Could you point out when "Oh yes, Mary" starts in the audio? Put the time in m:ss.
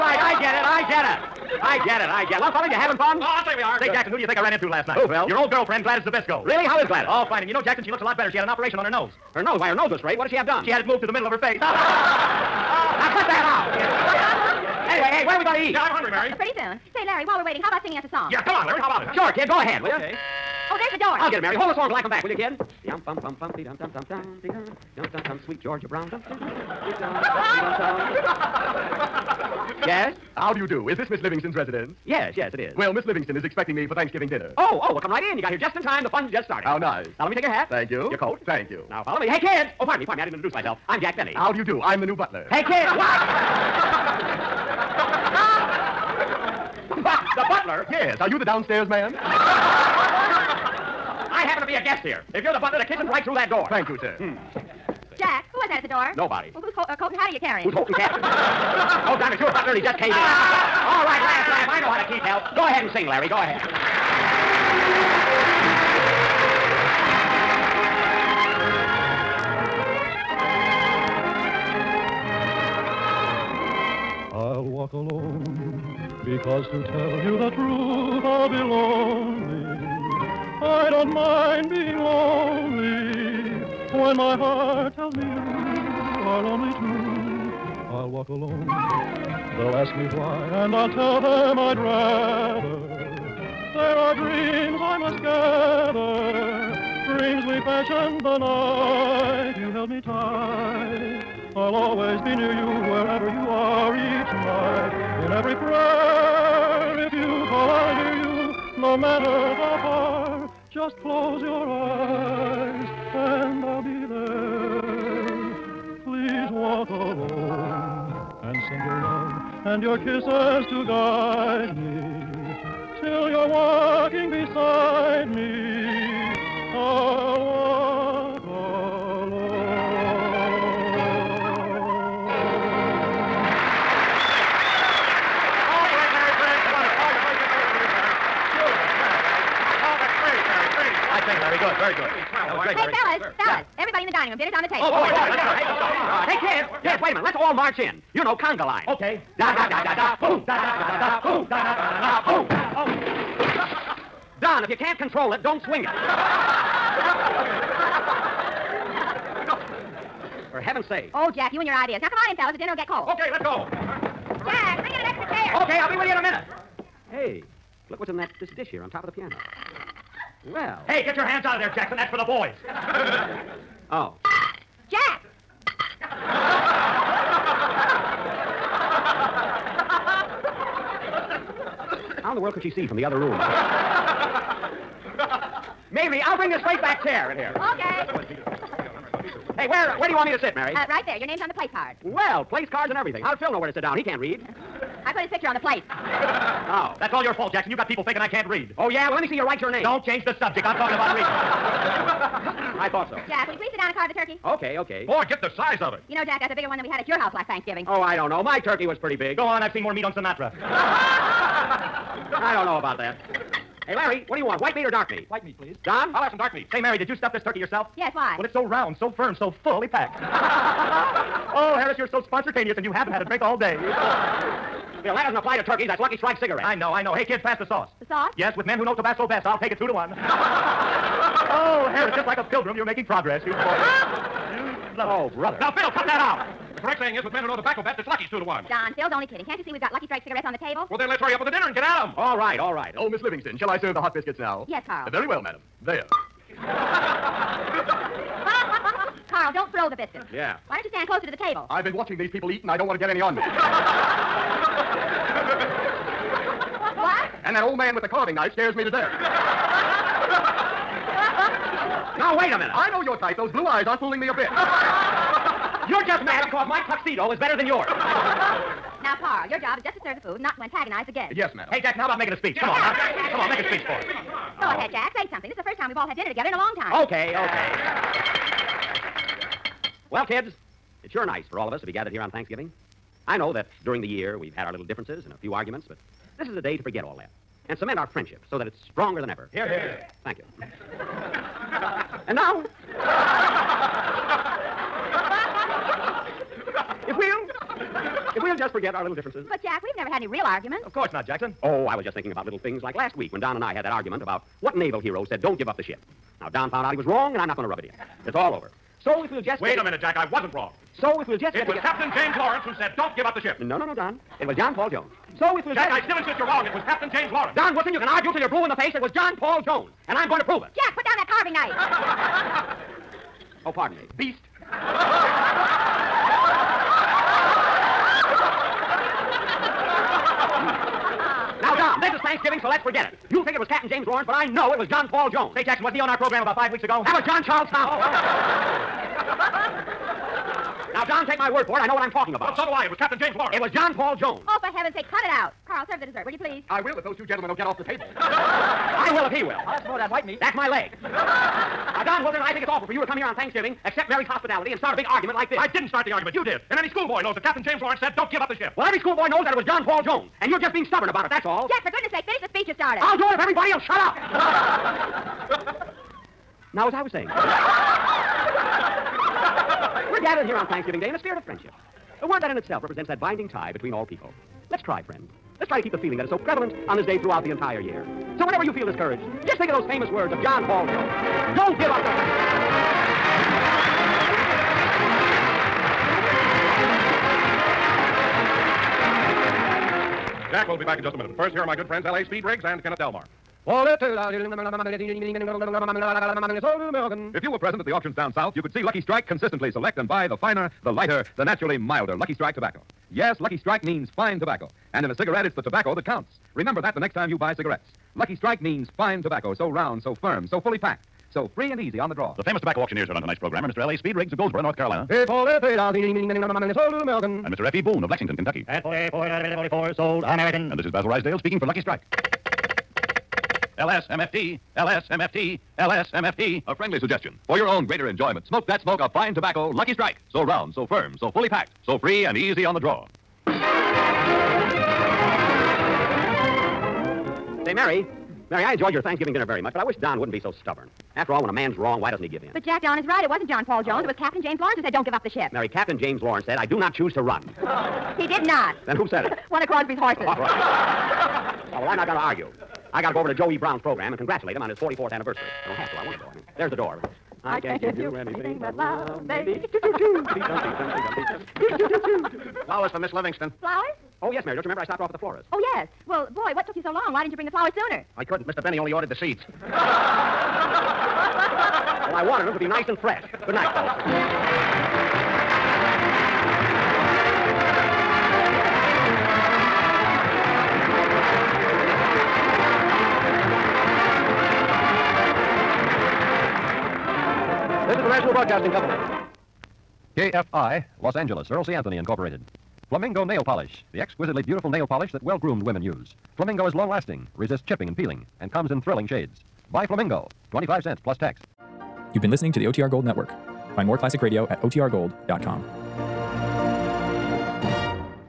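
7:44.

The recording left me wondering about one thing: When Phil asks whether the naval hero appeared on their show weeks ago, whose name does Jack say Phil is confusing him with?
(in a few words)
John Charles Thomas.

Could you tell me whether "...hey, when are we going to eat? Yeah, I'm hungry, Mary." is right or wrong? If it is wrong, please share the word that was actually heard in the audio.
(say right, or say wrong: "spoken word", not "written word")
right.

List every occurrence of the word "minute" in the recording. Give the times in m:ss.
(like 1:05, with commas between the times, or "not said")
2:27, 2:46, 4:22, 5:09, 6:31.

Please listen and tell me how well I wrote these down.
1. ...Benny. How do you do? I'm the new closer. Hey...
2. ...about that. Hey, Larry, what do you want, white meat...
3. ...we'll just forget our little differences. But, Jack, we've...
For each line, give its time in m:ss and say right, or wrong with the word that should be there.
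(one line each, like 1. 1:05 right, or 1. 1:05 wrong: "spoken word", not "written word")
1. 0:41 wrong: "butler", not "closer"
2. 3:32 right
3. 4:58 right.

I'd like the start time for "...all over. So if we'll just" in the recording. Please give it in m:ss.
5:08.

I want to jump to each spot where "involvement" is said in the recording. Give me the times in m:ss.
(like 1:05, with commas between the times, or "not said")
not said.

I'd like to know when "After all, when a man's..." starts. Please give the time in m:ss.
7:21.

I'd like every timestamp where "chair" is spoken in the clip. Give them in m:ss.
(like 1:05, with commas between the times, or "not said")
2:45, 3:07.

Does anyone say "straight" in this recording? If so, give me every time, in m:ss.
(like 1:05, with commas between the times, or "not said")
0:09, 3:06.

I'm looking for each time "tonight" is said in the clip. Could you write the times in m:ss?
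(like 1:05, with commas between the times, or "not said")
6:53.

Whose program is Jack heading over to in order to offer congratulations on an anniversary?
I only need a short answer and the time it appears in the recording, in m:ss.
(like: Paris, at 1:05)
Joe E. Brown, at 7:33.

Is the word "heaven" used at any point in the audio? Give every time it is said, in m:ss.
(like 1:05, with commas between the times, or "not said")
2:40, 5:44.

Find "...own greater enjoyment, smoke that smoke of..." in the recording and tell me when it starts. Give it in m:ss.
7:07.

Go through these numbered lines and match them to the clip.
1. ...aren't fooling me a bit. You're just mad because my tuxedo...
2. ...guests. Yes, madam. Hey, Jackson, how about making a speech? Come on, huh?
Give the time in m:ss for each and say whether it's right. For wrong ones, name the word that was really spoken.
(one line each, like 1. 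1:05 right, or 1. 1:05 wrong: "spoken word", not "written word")
1. 4:23 right
2. 4:31 right.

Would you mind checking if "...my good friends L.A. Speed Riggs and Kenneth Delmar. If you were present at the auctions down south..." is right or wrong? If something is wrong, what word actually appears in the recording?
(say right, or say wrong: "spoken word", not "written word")
right.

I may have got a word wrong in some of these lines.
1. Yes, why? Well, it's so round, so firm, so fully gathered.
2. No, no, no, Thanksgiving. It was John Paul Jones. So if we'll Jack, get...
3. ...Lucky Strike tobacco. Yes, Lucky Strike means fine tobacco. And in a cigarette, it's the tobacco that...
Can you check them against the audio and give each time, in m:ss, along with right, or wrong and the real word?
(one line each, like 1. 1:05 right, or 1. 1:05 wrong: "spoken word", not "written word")
1. 3:37 wrong: "packed", not "gathered"
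2. 5:13 wrong: "Don", not "Thanksgiving"
3. 6:42 right.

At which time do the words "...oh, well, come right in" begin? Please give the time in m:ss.
0:34.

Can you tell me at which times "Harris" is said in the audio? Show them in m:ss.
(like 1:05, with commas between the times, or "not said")
3:41, 3:51.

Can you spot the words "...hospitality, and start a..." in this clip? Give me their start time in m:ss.
5:54.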